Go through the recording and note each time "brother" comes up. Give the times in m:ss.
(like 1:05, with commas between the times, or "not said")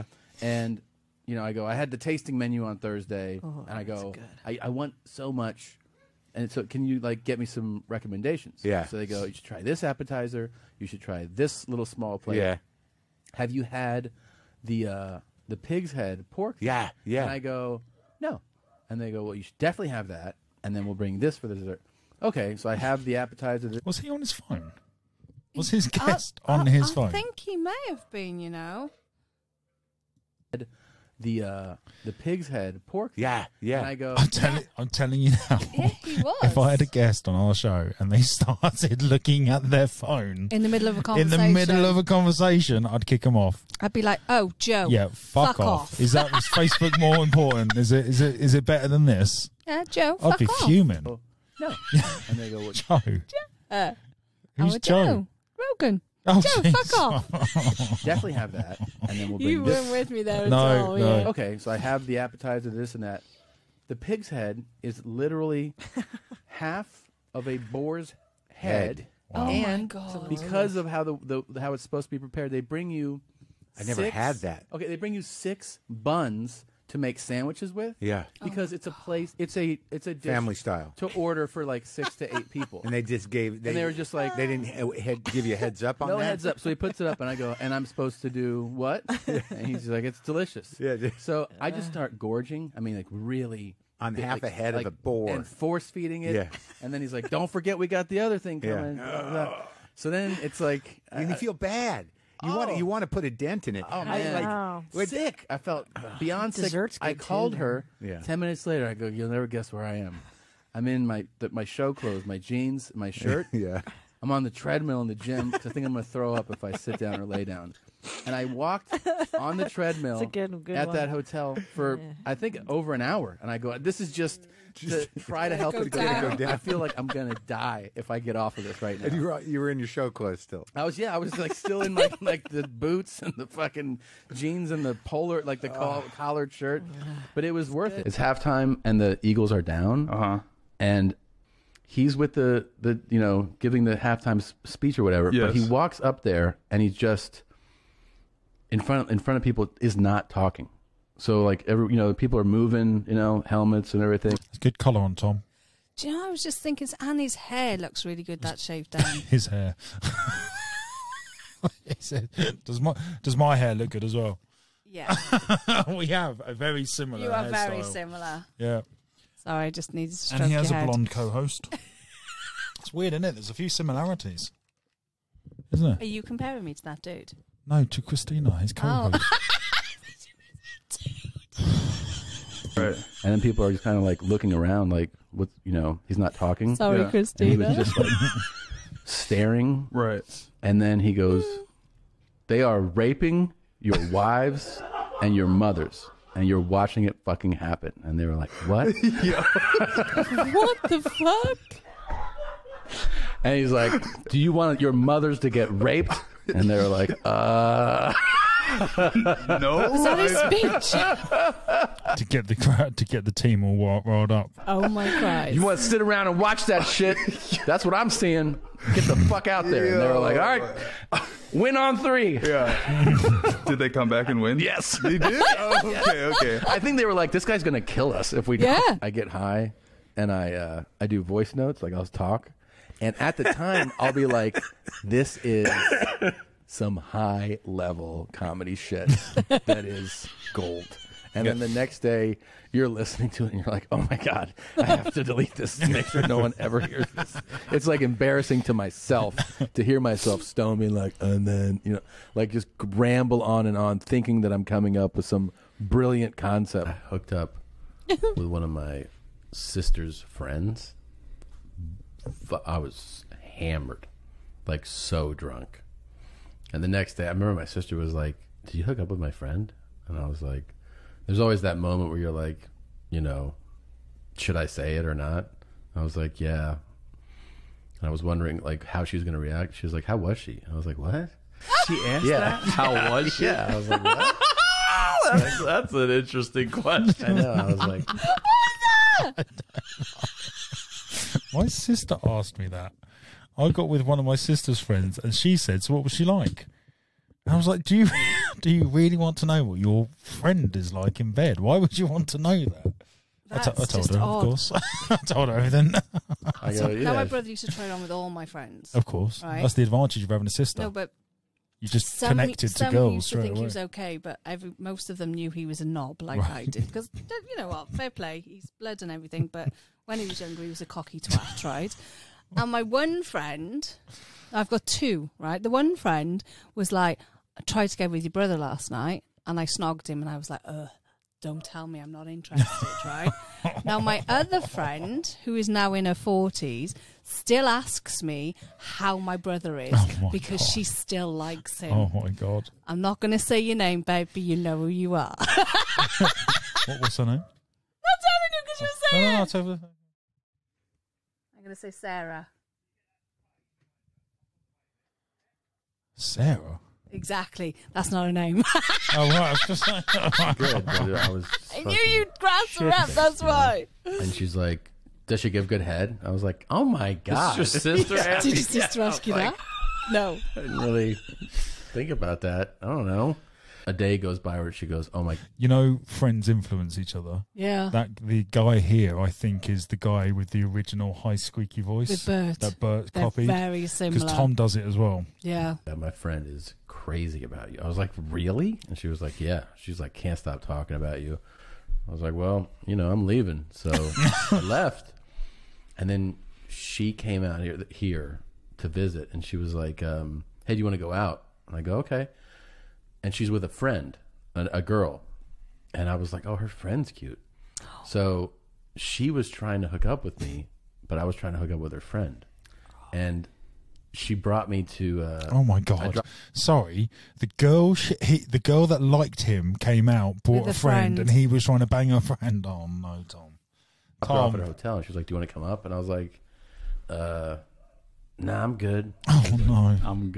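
5:07, 5:28, 5:39.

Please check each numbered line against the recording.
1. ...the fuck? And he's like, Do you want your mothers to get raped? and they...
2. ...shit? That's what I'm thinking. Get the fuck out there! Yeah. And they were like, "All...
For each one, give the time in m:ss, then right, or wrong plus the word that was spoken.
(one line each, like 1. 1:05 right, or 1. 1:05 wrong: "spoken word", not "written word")
1. 3:20 right
2. 3:36 wrong: "seeing", not "thinking".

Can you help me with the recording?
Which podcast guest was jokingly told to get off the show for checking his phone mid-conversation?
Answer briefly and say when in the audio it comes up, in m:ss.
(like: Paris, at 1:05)
Joe Rogan, at 0:55.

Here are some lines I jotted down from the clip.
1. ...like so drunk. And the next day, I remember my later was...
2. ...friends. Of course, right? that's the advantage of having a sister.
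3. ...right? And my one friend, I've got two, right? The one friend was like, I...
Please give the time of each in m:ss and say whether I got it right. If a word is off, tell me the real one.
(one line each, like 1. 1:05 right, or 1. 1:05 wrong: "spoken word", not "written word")
1. 4:24 wrong: "sister", not "later"
2. 5:08 right
3. 5:21 right.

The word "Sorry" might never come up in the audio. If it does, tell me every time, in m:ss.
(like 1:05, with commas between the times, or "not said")
2:49, 3:06, 6:56.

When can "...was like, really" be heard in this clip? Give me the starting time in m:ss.
6:27.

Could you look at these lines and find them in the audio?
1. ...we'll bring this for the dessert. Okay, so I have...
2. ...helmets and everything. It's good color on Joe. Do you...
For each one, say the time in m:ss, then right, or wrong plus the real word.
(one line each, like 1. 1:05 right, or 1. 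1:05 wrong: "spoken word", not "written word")
1. 0:20 right
2. 2:33 wrong: "Tom", not "Joe".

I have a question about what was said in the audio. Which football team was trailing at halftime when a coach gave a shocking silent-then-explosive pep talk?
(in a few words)
Eagles.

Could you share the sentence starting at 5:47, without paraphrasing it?
not telling you because you're No, saying no, no, it's over.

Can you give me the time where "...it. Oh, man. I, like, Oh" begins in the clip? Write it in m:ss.
1:43.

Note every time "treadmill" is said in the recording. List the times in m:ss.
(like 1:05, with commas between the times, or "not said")
1:54, 1:59.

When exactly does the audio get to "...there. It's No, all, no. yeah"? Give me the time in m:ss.
1:00.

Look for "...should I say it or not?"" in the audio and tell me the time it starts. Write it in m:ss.
4:34.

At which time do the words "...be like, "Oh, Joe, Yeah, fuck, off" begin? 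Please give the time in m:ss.
0:43.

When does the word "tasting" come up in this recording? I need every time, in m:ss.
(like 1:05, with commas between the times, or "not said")
0:01.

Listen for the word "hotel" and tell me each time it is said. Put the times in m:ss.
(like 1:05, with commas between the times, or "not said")
2:01, 7:04.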